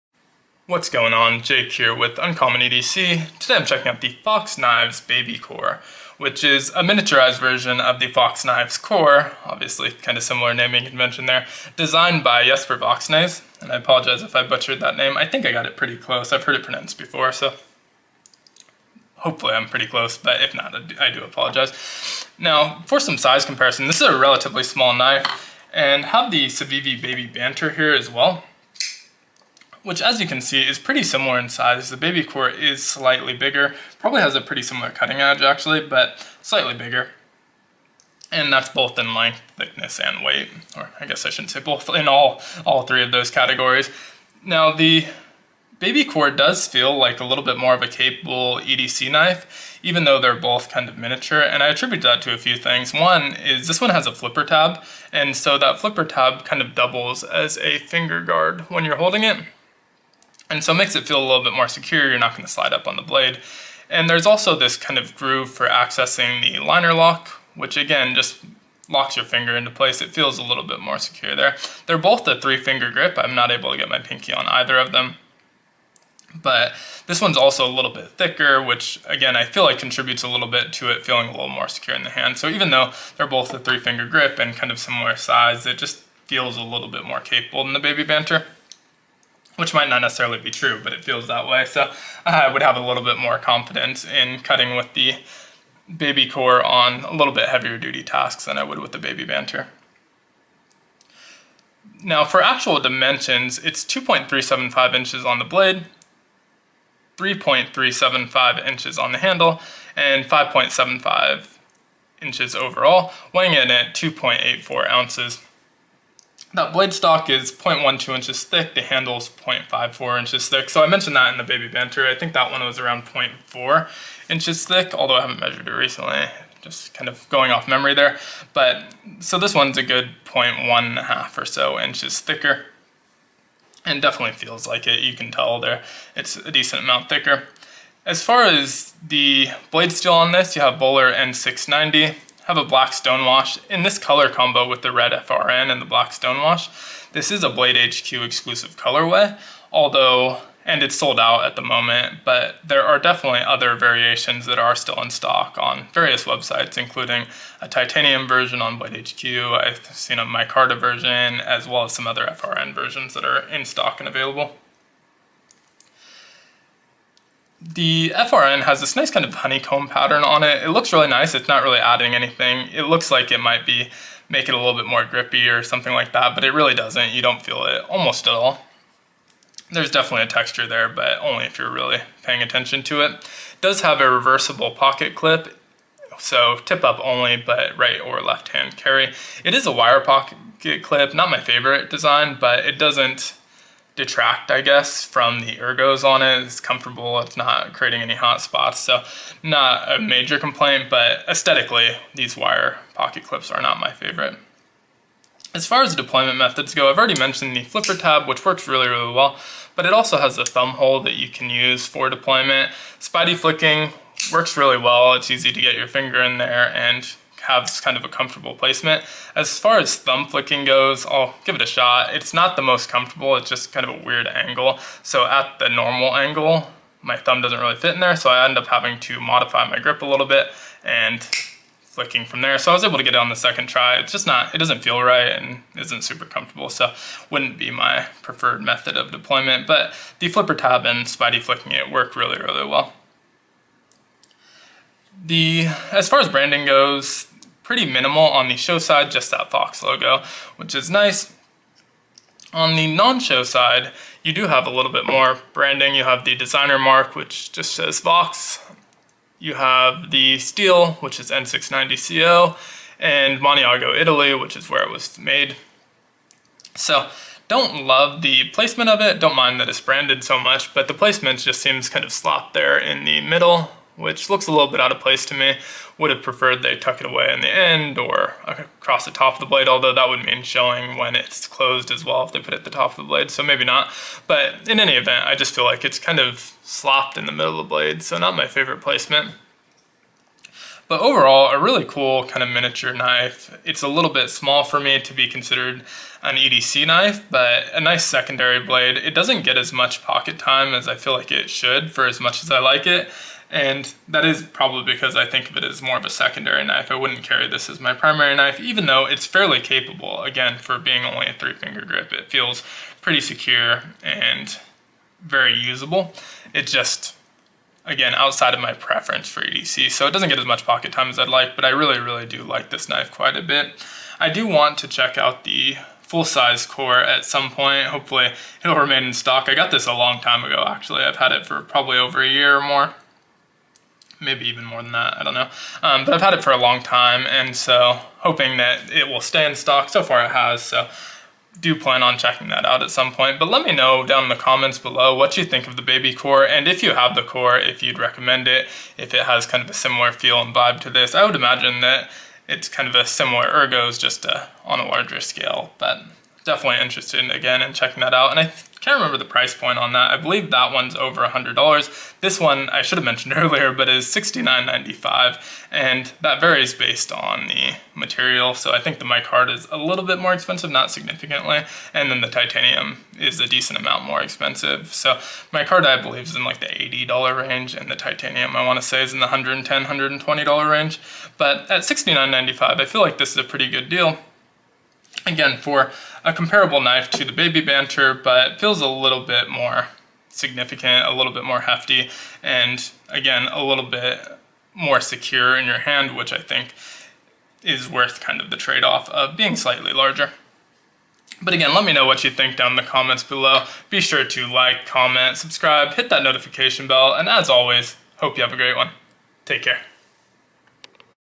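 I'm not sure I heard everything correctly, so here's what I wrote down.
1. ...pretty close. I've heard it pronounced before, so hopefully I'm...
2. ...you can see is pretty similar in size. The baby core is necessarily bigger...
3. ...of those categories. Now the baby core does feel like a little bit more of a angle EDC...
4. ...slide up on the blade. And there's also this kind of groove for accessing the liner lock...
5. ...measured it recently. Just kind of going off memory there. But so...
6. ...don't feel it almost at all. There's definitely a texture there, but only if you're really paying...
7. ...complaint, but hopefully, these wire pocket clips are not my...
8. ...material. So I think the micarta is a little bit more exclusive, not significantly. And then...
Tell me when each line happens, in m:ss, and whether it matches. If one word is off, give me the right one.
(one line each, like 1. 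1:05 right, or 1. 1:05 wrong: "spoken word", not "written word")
1. 0:15 right
2. 0:30 wrong: "slightly", not "necessarily"
3. 0:43 wrong: "capable", not "angle"
4. 1:02 right
5. 2:05 right
6. 2:57 right
7. 3:20 wrong: "aesthetically", not "hopefully"
8. 6:07 wrong: "expensive", not "exclusive".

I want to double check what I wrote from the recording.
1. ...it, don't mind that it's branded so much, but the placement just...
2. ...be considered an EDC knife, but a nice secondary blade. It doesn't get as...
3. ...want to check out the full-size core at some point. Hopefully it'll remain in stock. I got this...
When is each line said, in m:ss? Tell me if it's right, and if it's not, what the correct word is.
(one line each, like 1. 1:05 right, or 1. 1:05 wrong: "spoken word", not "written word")
1. 4:28 right
2. 4:55 right
3. 5:24 right.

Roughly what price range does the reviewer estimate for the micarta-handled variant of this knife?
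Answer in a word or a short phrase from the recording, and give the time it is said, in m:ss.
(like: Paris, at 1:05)
$80 range, at 6:16.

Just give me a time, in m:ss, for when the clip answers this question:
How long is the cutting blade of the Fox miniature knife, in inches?
1:43.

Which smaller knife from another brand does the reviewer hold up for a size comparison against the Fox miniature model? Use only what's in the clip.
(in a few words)
Civivi Baby Banter.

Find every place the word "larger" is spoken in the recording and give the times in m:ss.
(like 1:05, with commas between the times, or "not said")
5:54, 6:39.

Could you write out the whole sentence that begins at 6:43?
Be sure to like, comment, subscribe, hit that notification bell, and as always, hope you have a great one.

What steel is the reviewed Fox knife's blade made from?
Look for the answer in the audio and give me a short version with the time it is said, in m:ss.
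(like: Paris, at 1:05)
Bohler N690, at 2:20.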